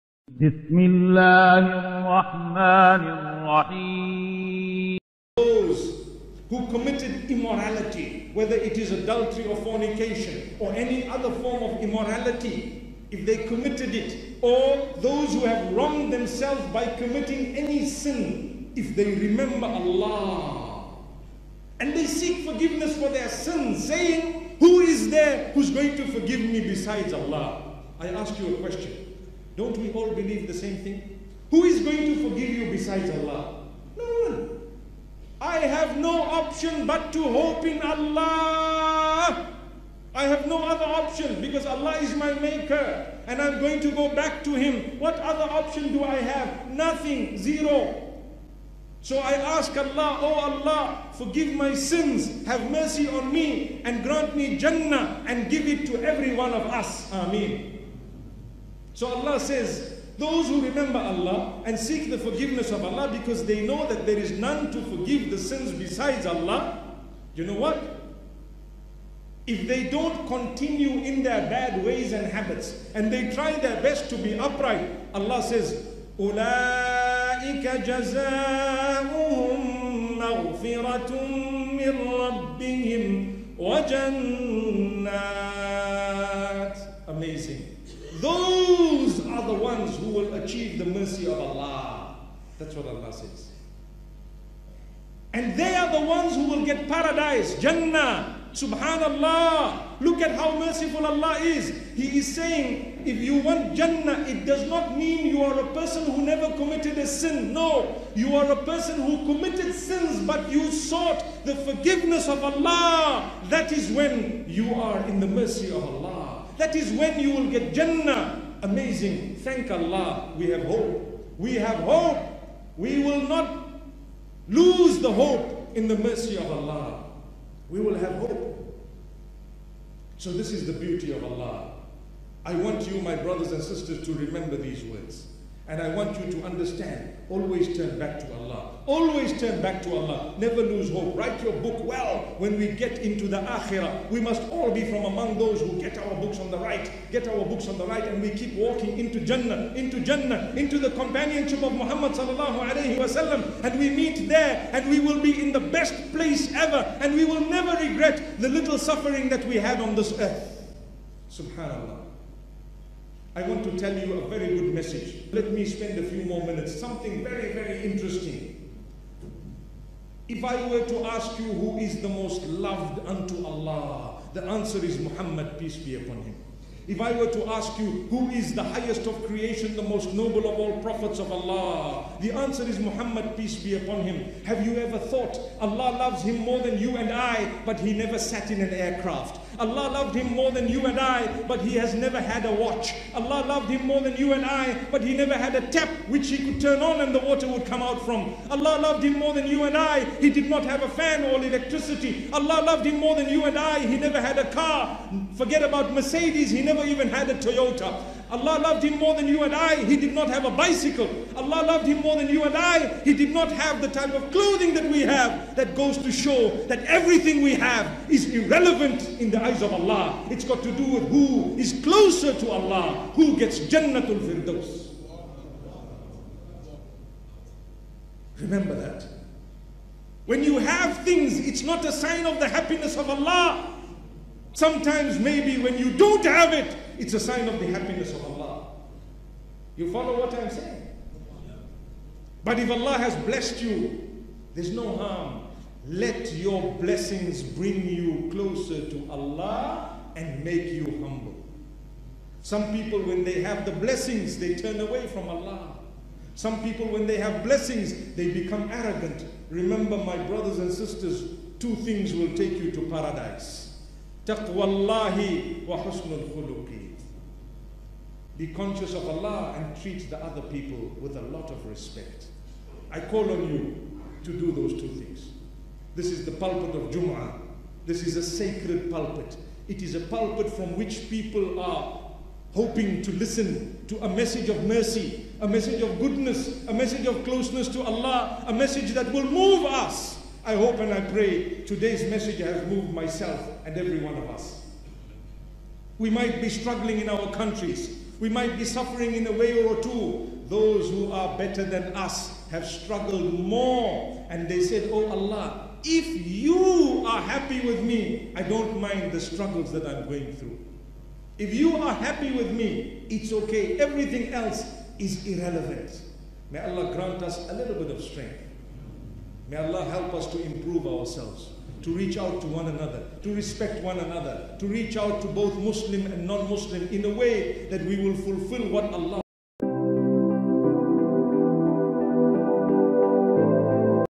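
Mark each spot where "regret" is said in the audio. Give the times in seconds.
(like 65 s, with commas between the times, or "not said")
157 s.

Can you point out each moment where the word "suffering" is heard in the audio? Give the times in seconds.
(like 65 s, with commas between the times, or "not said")
158 s, 298 s.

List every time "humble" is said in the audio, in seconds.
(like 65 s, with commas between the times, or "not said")
251 s.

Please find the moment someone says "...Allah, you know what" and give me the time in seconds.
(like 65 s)
66 s.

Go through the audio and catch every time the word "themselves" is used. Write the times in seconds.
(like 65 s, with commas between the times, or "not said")
16 s.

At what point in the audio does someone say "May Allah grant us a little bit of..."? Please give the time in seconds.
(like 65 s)
316 s.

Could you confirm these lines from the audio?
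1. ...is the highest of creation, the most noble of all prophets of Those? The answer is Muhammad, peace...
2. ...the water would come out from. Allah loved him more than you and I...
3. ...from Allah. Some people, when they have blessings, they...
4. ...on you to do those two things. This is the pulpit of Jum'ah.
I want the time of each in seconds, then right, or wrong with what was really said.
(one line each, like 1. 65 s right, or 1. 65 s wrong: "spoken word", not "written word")
1. 178 s wrong: "Allah", not "Those"
2. 197 s right
3. 255 s right
4. 273 s right.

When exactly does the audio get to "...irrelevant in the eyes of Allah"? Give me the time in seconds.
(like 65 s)
218 s.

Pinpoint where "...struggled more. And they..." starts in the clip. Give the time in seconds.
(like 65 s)
302 s.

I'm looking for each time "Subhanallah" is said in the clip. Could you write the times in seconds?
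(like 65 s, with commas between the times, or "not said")
98 s, 161 s.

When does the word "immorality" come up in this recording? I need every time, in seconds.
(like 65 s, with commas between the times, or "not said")
7 s, 11 s.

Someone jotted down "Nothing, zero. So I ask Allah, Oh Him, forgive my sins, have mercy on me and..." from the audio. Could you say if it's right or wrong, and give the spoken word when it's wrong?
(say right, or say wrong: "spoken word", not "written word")
wrong: "Allah", not "Him".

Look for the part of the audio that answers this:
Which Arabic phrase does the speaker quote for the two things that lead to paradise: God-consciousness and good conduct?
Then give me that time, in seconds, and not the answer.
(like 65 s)
264 s.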